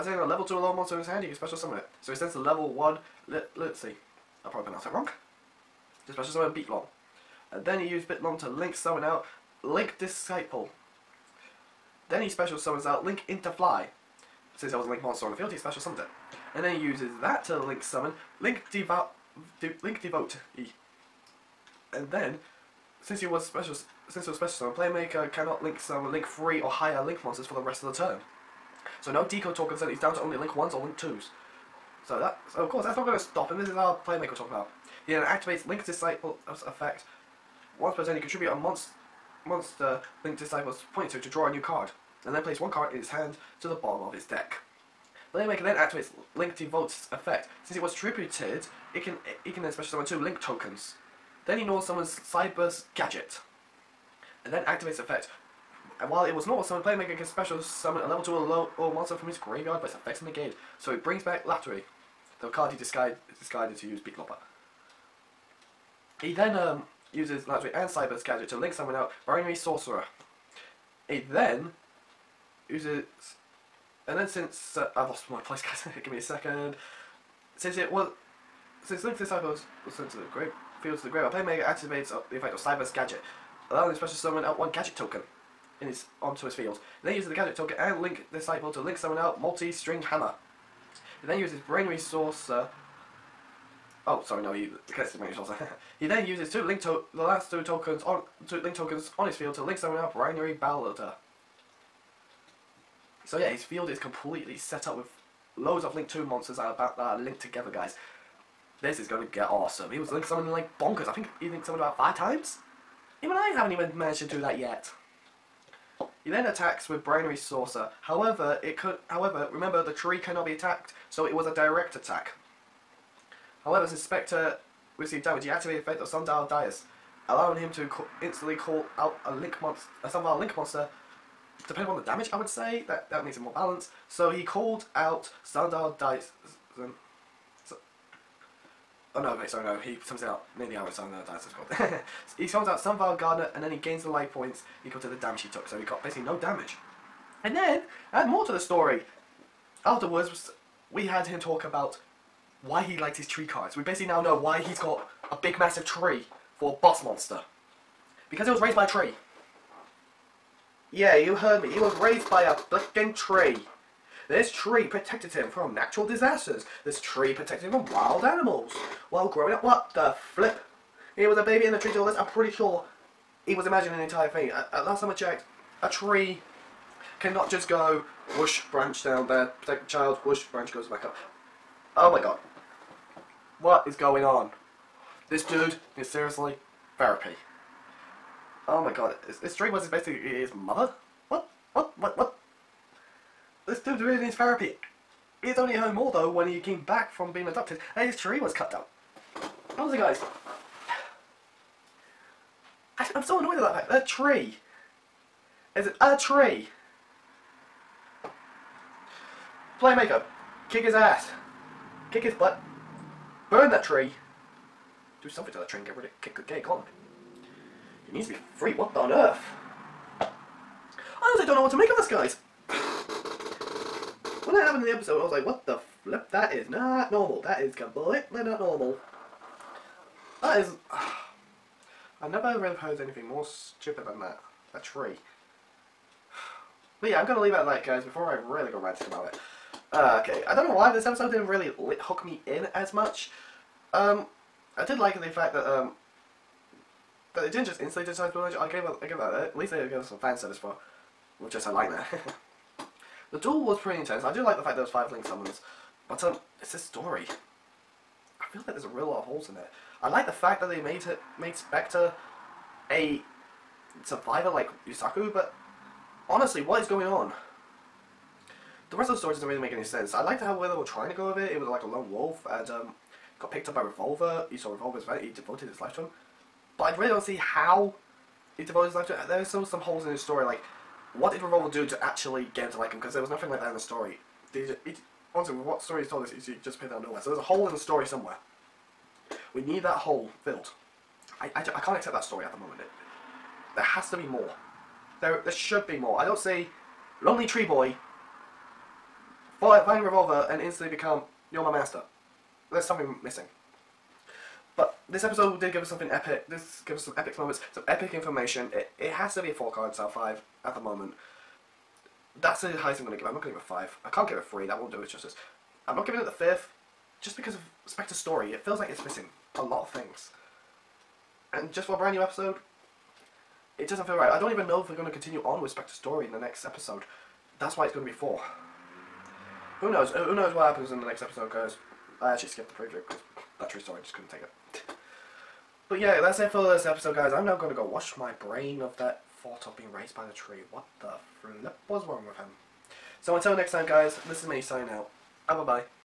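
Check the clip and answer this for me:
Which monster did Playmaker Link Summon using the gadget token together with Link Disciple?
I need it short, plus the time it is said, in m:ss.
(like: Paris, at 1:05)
Multi-String Hammer, at 1:29.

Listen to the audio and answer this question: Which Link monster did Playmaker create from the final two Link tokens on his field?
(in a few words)
Binary Blader.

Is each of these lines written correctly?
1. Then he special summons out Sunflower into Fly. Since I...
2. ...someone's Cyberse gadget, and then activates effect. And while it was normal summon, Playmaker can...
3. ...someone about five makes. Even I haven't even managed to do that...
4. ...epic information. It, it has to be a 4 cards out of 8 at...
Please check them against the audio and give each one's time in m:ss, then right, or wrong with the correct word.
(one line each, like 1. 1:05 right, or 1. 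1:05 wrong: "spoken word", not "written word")
1. 0:12 wrong: "Link", not "Sunflower"
2. 0:51 right
3. 1:51 wrong: "times", not "makes"
4. 5:07 wrong: "5", not "8".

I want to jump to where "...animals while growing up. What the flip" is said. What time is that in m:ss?
2:48.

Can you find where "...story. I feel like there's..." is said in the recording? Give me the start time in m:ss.
4:16.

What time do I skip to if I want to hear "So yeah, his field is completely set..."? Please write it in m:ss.
1:43.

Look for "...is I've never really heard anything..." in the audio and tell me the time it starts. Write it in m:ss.
3:50.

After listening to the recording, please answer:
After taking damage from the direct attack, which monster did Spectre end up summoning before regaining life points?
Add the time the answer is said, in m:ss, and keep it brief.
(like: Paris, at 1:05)
Sunflower Gardener, at 2:22.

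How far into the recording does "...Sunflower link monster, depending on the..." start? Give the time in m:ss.
2:10.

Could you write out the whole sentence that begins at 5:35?
But yeah, that's it for this episode, guys.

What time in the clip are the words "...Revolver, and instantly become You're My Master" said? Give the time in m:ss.
5:00.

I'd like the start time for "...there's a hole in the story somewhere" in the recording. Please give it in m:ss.
4:47.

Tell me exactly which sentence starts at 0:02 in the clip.
So he sends the level 1 let, let's see.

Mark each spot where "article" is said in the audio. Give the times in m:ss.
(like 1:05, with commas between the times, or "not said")
not said.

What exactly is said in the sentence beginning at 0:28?
So no decode tokens and he's down to only Link 1s or Link 2s.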